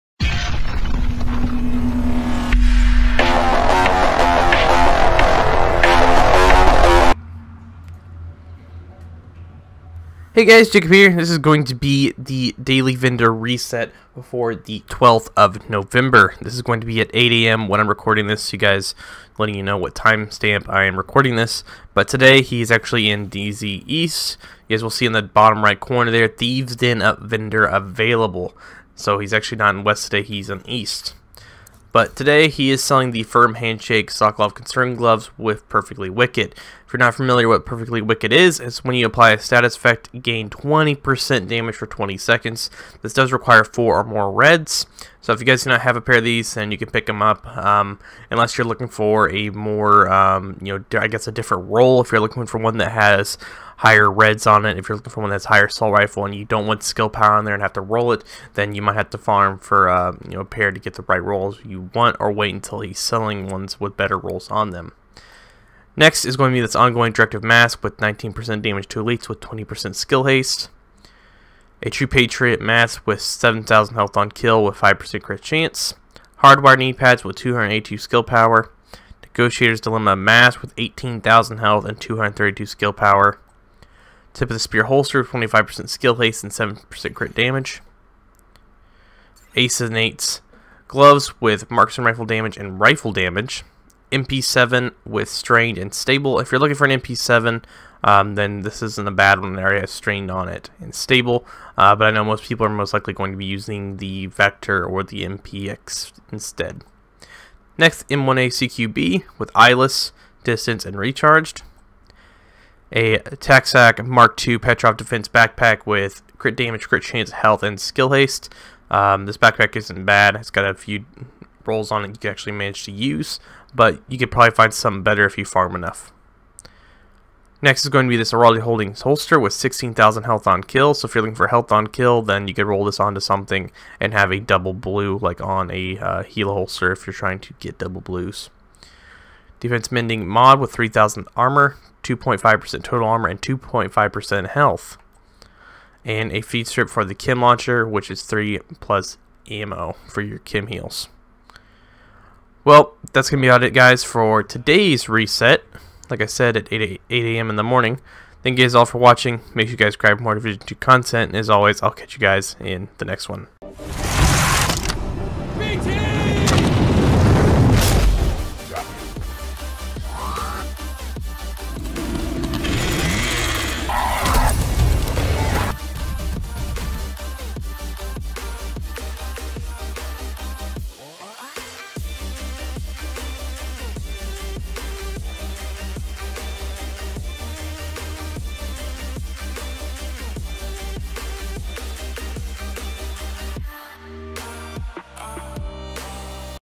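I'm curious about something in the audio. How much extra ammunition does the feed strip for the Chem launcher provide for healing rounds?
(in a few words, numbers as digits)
3 plus.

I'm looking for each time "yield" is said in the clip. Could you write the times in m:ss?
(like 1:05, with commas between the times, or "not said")
not said.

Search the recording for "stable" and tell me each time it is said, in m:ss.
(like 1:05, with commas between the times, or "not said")
1:35, 1:40.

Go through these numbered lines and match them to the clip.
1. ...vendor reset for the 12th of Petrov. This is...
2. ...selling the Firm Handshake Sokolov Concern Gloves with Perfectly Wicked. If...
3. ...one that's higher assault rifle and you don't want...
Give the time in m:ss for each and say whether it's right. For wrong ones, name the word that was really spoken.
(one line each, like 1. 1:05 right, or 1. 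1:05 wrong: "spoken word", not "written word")
1. 0:12 wrong: "November", not "Petrov"
2. 0:32 right
3. 0:55 right.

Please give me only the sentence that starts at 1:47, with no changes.
Next, M1ACQB with eyeless, distance, and recharged.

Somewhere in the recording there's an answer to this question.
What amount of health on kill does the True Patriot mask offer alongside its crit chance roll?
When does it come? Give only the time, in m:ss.
1:13.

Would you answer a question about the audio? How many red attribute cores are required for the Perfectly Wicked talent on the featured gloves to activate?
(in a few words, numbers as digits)
4 or more.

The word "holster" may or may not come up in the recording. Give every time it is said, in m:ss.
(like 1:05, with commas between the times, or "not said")
1:24, 2:09, 2:16.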